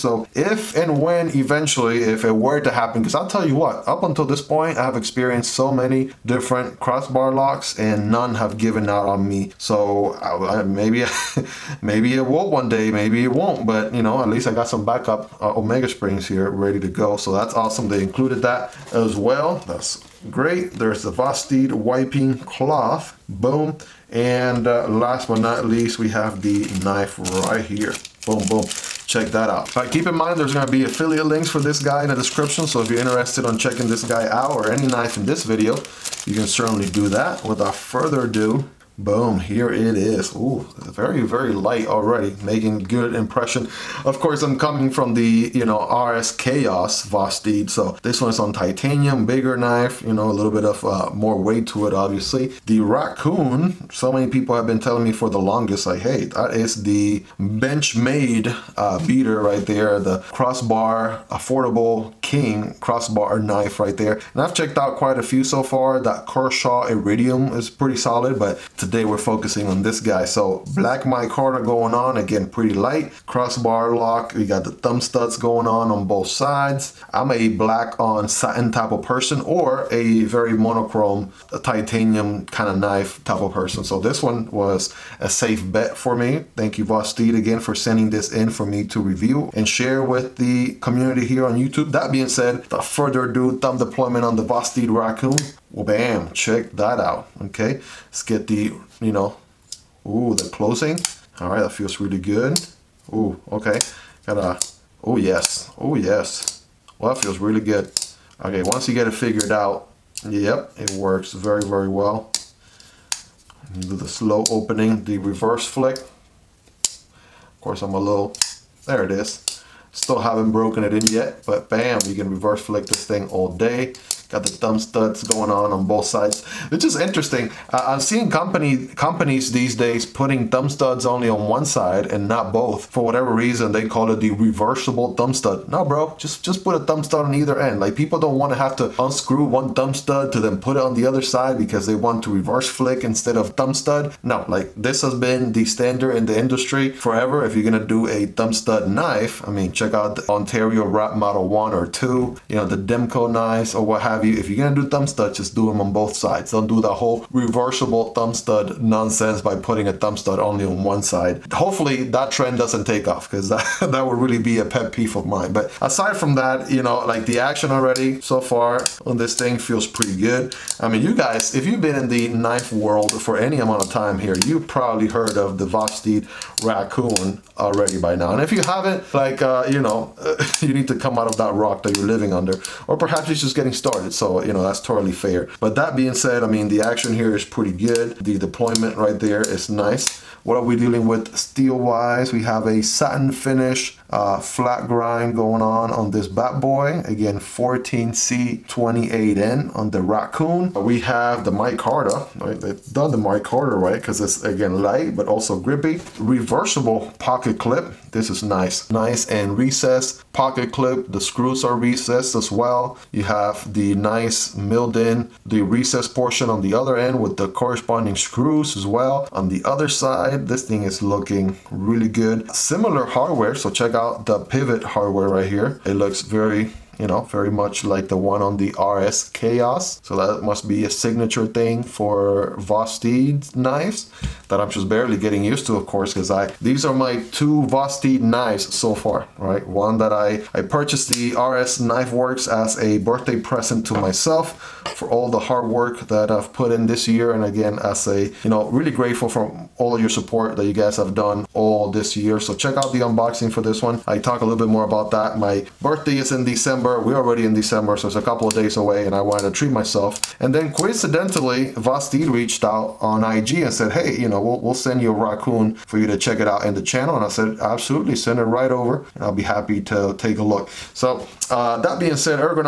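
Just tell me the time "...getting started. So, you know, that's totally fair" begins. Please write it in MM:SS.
03:03.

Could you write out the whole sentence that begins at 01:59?
Still haven't broken it in yet, but bam, you can reverse flick this thing all day.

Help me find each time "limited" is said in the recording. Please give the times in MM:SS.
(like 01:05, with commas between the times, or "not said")
not said.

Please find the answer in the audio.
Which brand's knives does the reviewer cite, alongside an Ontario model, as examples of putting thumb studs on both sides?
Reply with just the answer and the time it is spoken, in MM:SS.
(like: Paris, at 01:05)
Demko, at 02:32.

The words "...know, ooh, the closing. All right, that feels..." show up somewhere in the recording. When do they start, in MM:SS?
01:39.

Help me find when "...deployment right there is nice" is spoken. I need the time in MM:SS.
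03:08.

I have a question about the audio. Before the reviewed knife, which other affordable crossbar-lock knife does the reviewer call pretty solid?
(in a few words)
Kershaw Iridium.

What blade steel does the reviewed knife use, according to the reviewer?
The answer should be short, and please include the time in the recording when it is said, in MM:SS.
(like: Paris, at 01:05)
14C28N, at 03:17.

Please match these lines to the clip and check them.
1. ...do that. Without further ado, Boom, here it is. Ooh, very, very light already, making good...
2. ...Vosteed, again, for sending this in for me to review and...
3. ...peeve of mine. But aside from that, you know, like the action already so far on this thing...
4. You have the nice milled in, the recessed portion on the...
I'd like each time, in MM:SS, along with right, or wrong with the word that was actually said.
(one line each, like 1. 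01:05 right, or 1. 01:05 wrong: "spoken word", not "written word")
1. 00:36 right
2. 01:26 right
3. 02:44 right
4. 03:33 right.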